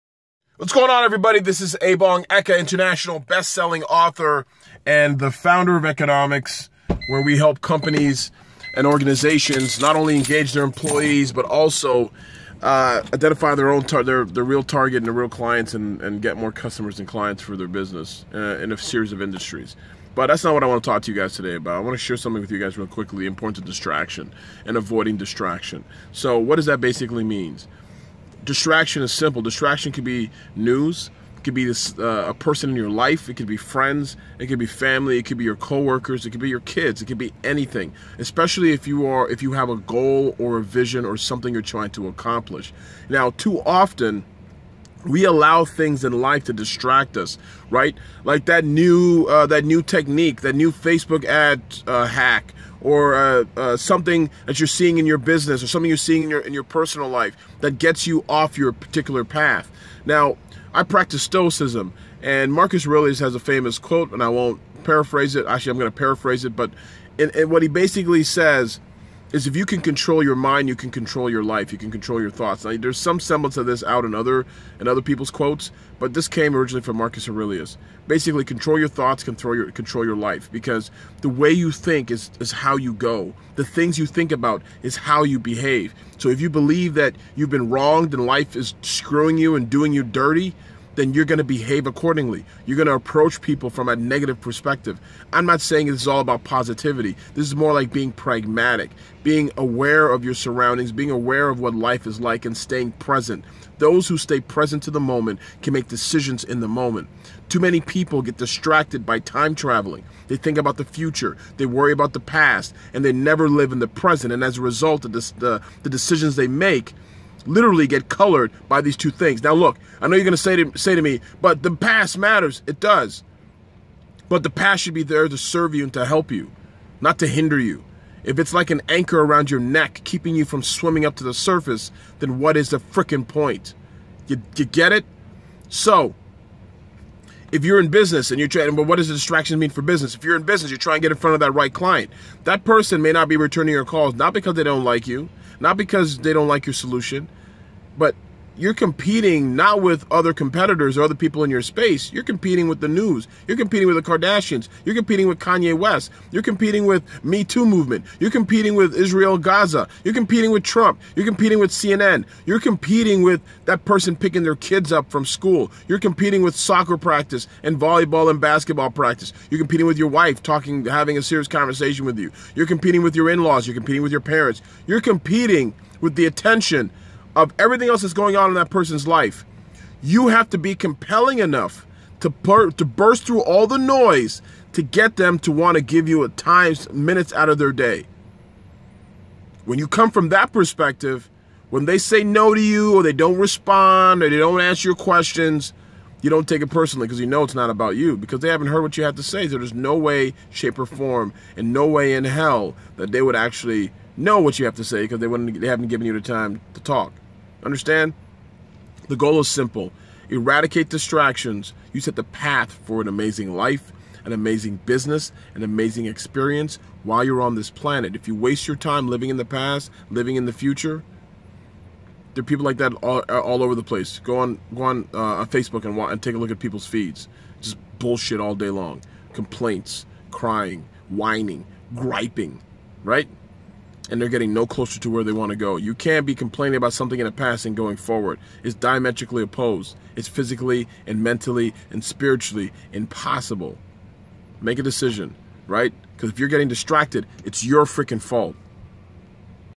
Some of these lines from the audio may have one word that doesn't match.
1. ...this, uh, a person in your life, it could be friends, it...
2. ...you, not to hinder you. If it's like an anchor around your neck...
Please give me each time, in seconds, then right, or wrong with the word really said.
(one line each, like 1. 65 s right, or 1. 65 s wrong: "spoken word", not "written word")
1. 31 s right
2. 126 s right.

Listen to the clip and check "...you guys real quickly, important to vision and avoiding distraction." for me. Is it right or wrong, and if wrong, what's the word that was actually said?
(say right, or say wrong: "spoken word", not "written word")
wrong: "distraction", not "vision".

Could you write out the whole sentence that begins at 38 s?
Especially if you are if you have a goal or a vision or something you're trying to accomplish.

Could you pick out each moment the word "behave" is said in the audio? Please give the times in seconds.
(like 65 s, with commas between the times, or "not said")
85 s, 91 s.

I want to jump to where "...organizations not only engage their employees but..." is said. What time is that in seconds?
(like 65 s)
8 s.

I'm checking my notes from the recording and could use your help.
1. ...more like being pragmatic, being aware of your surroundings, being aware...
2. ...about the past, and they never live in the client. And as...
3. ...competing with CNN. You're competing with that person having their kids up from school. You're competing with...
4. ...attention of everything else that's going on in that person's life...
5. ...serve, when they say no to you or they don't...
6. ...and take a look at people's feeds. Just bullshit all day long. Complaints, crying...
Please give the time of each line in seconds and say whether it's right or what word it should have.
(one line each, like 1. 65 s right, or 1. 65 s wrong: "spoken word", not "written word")
1. 97 s right
2. 111 s wrong: "present", not "client"
3. 161 s wrong: "picking", not "having"
4. 176 s right
5. 190 s wrong: "perspective", not "serve"
6. 225 s right.